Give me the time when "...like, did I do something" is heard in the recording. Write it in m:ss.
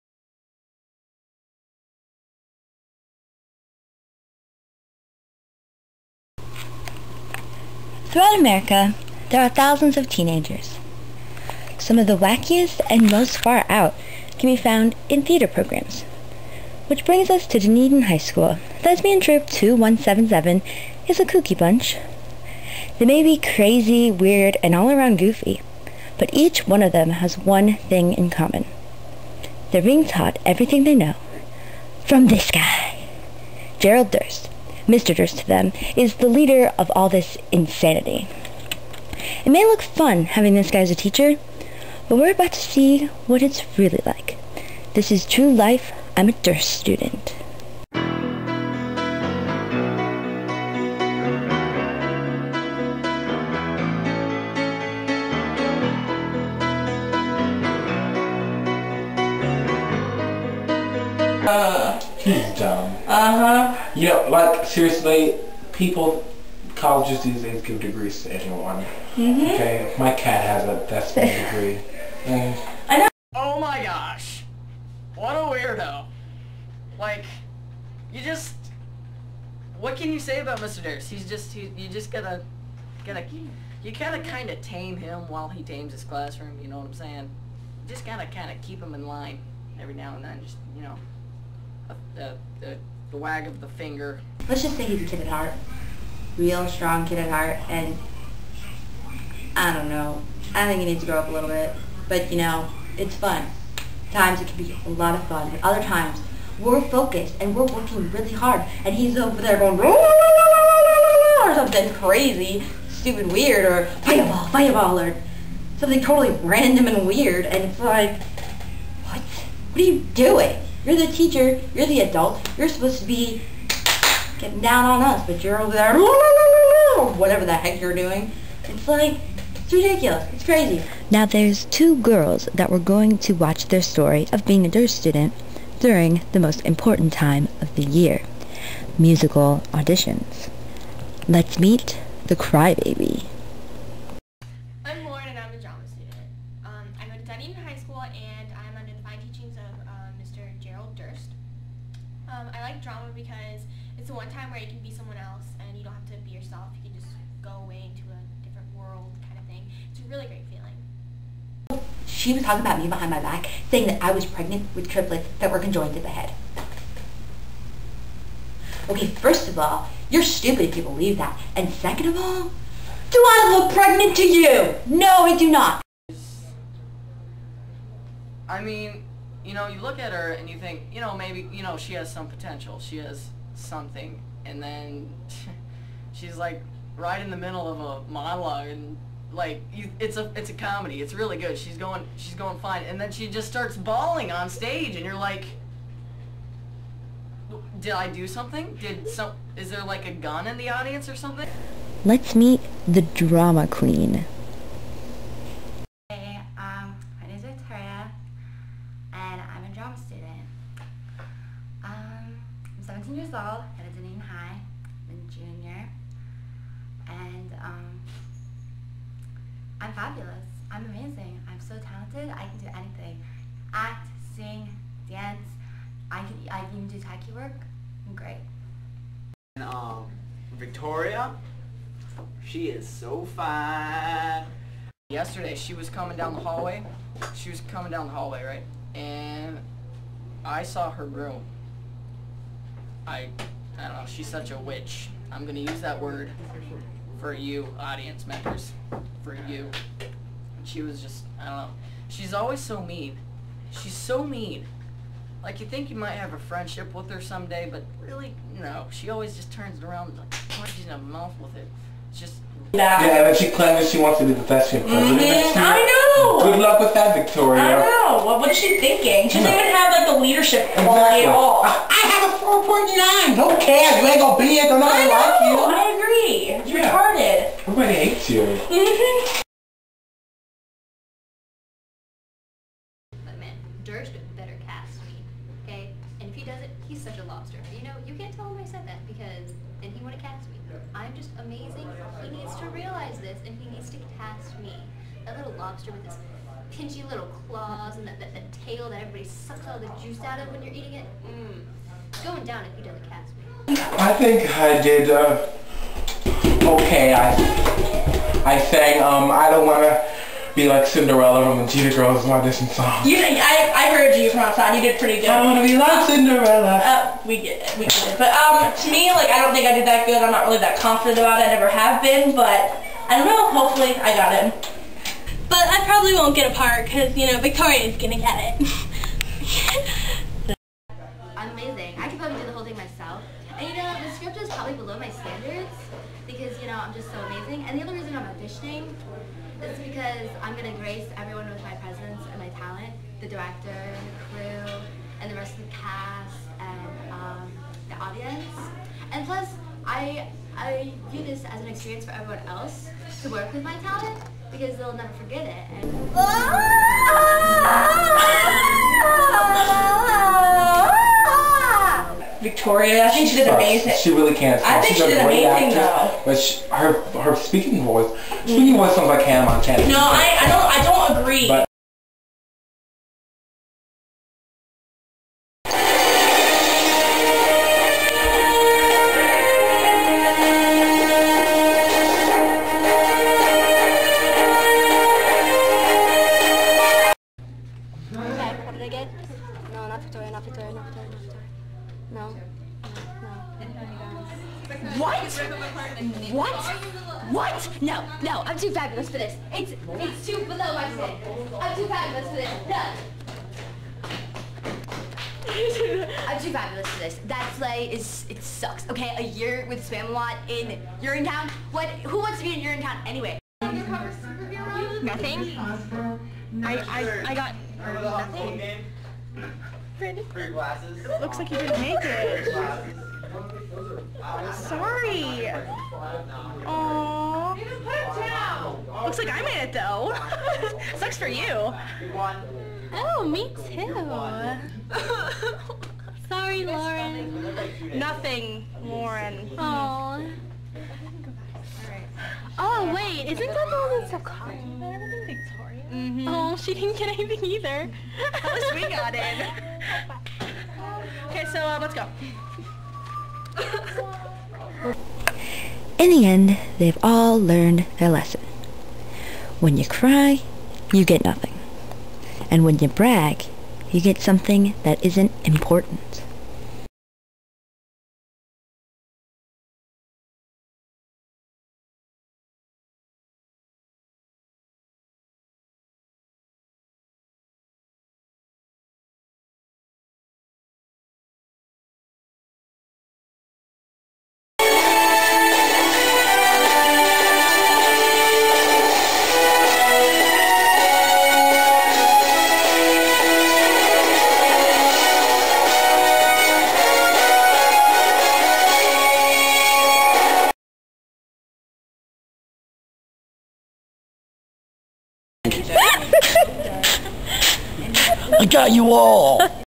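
3:15.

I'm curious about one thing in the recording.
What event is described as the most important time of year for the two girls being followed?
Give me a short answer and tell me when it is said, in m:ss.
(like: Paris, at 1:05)
Musical auditions, at 2:18.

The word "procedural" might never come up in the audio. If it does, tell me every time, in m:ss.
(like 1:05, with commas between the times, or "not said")
not said.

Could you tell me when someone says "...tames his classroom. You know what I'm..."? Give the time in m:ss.
1:25.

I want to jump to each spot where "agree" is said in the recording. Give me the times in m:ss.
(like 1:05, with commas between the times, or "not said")
4:35, 6:11.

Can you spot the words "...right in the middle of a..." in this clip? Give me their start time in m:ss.
3:06.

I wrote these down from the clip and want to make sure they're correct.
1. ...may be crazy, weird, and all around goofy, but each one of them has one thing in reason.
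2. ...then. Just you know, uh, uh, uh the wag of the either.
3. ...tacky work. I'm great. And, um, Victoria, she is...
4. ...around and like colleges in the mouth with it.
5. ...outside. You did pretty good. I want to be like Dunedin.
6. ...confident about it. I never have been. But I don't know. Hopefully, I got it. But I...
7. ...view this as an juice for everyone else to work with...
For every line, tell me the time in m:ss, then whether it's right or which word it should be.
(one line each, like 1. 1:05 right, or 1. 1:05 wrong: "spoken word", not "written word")
1. 0:23 wrong: "common", not "reason"
2. 1:30 wrong: "finger", not "either"
3. 3:46 right
4. 4:19 wrong: "punches", not "colleges"
5. 5:14 wrong: "Cinderella", not "Dunedin"
6. 5:20 right
7. 5:51 wrong: "experience", not "juice".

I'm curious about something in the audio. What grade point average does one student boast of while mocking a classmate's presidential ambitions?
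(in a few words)
4.9.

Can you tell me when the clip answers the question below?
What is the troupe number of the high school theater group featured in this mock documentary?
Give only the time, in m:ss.
0:18.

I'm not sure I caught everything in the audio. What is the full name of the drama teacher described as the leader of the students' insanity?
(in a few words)
Gerald Durst.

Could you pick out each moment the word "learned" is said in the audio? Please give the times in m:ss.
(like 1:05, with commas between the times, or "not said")
7:37.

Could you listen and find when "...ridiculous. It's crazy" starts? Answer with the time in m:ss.
2:09.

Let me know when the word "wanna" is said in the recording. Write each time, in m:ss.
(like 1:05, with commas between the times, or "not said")
5:09.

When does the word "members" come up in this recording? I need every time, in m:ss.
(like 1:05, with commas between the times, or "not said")
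4:08.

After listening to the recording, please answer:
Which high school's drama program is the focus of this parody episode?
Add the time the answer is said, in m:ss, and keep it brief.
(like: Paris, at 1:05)
Dunedin High School, at 0:17.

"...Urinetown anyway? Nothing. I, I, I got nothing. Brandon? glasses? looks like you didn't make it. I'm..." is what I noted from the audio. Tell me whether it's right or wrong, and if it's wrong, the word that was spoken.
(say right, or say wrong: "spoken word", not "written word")
right.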